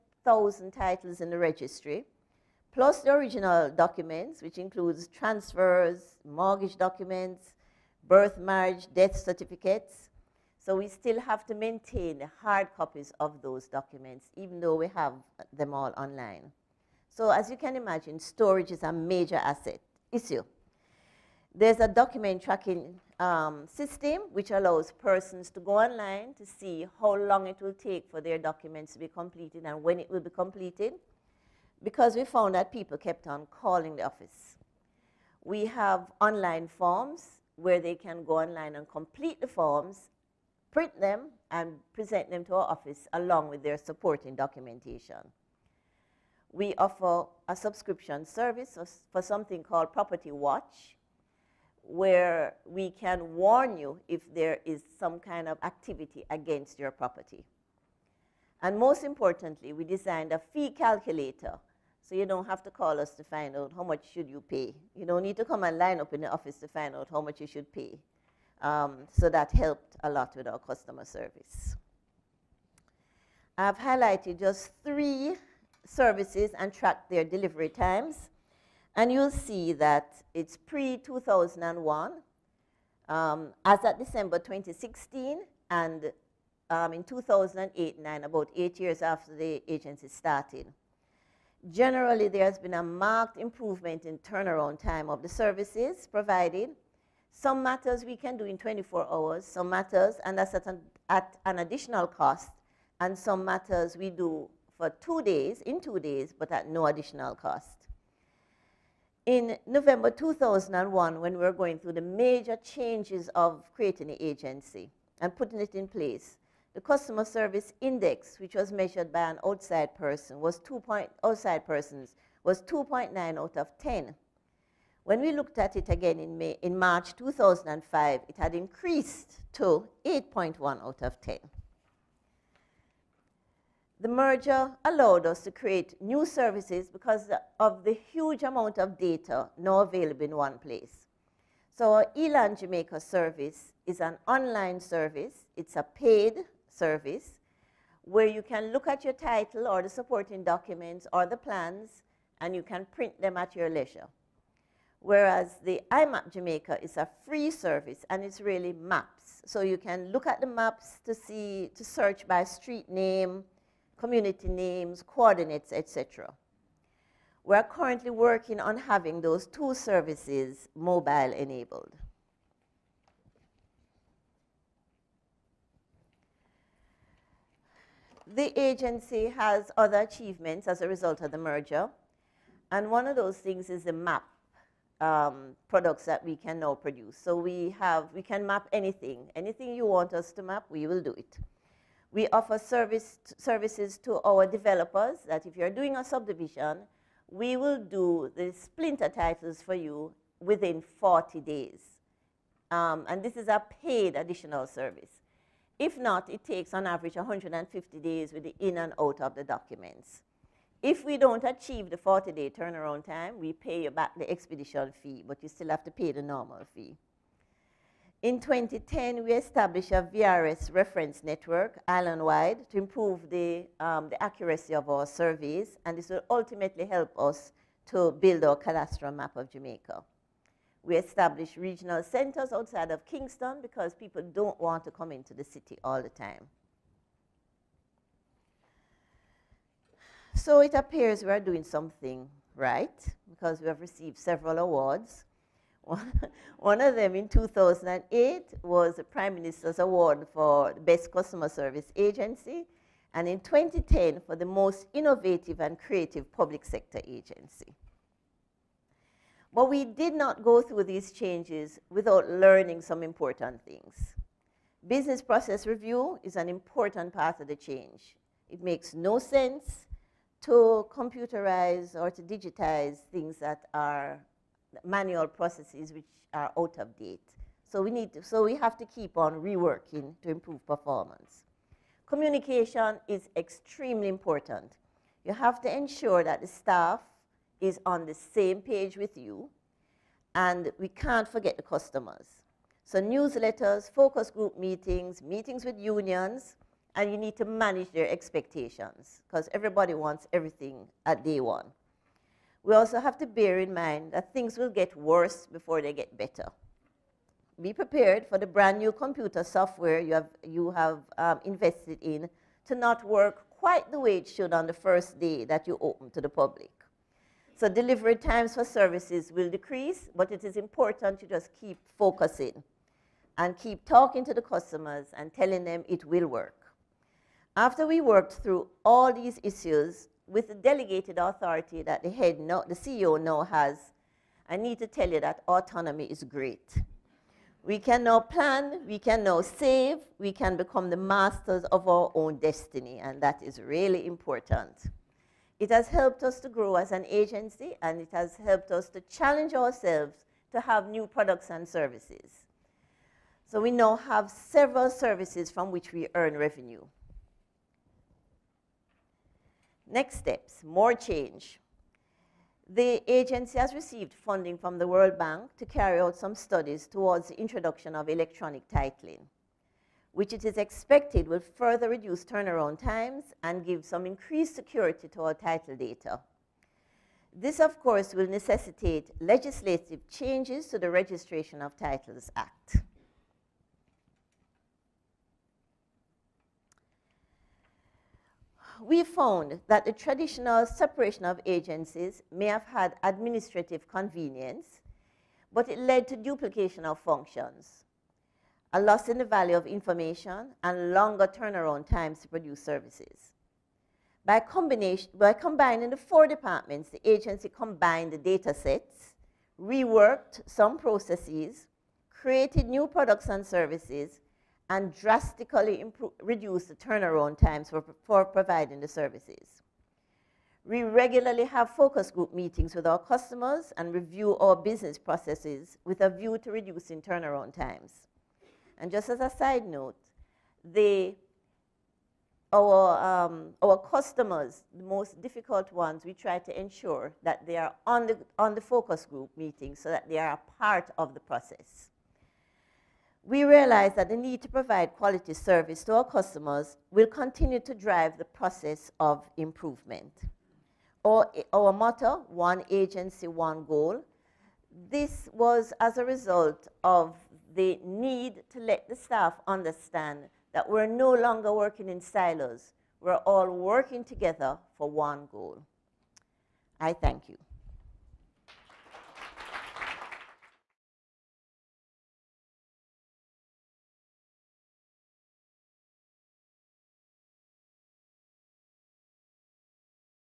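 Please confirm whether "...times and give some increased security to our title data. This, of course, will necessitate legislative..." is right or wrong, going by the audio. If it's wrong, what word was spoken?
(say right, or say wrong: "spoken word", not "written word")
right.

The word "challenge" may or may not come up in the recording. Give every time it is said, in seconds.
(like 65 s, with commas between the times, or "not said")
349 s.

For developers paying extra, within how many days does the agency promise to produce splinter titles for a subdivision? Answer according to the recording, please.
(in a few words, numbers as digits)
40 days.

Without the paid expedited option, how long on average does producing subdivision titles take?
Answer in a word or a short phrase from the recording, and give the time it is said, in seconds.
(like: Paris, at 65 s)
150 days, at 207 s.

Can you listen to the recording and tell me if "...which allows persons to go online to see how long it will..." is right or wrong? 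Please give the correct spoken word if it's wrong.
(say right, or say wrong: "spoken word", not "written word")
right.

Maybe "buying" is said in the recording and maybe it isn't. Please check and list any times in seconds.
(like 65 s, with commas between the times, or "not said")
not said.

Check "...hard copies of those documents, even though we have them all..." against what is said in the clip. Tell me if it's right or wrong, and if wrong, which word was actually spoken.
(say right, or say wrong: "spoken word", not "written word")
right.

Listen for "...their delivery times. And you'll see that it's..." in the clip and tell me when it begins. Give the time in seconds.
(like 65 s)
77 s.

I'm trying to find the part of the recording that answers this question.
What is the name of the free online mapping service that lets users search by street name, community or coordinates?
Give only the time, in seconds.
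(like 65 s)
155 s.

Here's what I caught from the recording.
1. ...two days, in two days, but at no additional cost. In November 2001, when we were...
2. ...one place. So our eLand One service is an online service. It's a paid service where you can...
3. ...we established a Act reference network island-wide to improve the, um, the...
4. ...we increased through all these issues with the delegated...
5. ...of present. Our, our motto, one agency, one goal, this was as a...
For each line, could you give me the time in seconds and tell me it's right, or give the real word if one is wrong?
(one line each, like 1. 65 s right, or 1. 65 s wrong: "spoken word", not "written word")
1. 105 s right
2. 140 s wrong: "Jamaica", not "One"
3. 219 s wrong: "VRS", not "Act"
4. 327 s wrong: "worked", not "increased"
5. 448 s wrong: "improvement", not "present".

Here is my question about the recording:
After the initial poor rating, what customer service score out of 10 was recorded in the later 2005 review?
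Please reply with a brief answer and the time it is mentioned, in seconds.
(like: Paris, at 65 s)
8.1, at 130 s.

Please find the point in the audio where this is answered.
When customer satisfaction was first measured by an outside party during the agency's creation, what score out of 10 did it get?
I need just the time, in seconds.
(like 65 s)
122 s.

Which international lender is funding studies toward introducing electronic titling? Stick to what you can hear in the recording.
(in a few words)
World Bank.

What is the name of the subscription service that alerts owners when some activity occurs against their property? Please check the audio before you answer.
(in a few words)
Property Watch.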